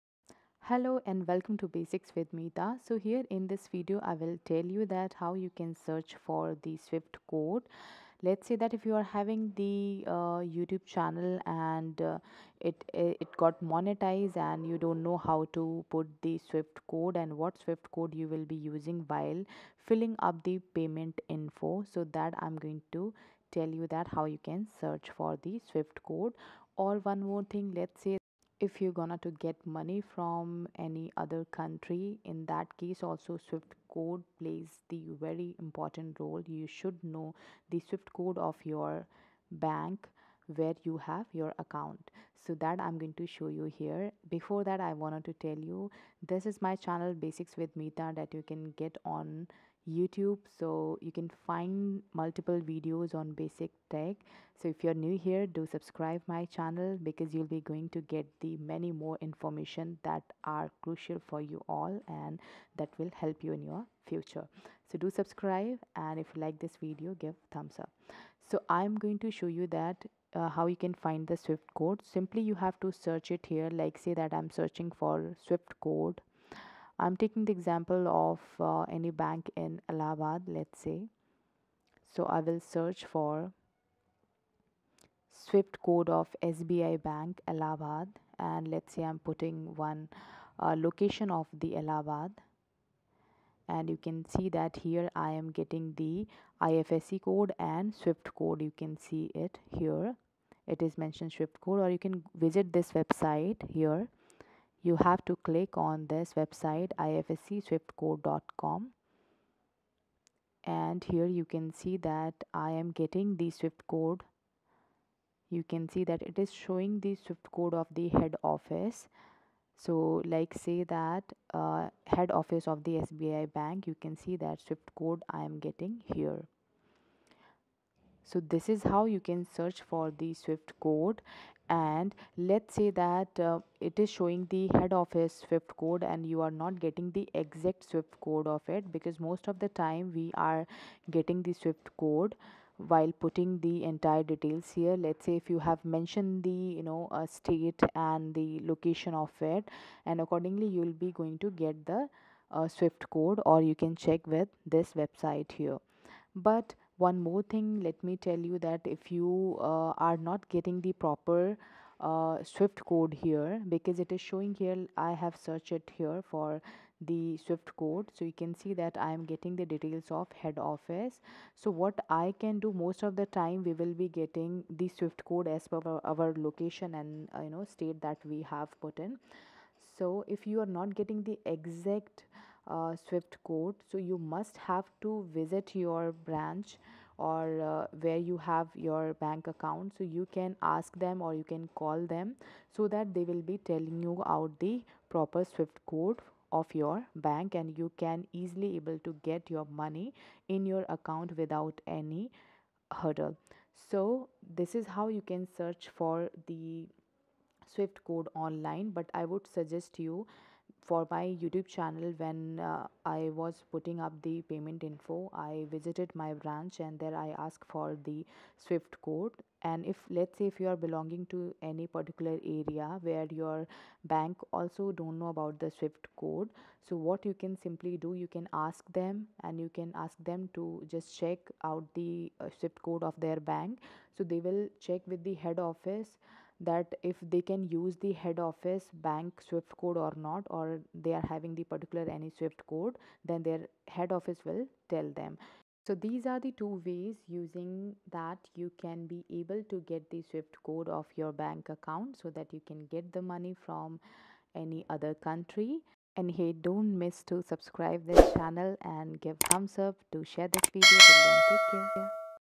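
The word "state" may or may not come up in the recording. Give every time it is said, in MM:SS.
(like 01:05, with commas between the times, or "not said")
02:27, 02:57.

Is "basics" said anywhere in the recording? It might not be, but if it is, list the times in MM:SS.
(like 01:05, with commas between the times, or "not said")
00:01, 00:47, 00:53.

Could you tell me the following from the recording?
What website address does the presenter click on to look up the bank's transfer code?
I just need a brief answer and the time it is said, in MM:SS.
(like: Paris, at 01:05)
ifscswiftcode.com, at 01:46.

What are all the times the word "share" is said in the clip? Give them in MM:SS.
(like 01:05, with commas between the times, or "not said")
04:20.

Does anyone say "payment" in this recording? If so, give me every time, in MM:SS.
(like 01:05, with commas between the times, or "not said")
00:20, 03:34.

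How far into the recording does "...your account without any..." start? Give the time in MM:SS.
03:20.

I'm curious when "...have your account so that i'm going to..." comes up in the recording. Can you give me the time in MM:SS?
00:40.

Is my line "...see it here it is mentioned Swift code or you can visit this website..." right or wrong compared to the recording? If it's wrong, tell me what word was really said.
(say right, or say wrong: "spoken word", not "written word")
right.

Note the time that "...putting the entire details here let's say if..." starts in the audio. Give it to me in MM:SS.
02:23.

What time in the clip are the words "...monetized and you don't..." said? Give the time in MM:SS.
00:13.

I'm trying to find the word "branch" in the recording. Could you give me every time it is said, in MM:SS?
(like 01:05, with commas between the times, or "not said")
03:06, 03:36.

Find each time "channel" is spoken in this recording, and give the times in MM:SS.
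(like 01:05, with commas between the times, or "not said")
00:10, 00:46, 00:56, 03:31, 04:18.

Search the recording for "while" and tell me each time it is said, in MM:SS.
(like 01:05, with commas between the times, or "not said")
00:19, 02:22.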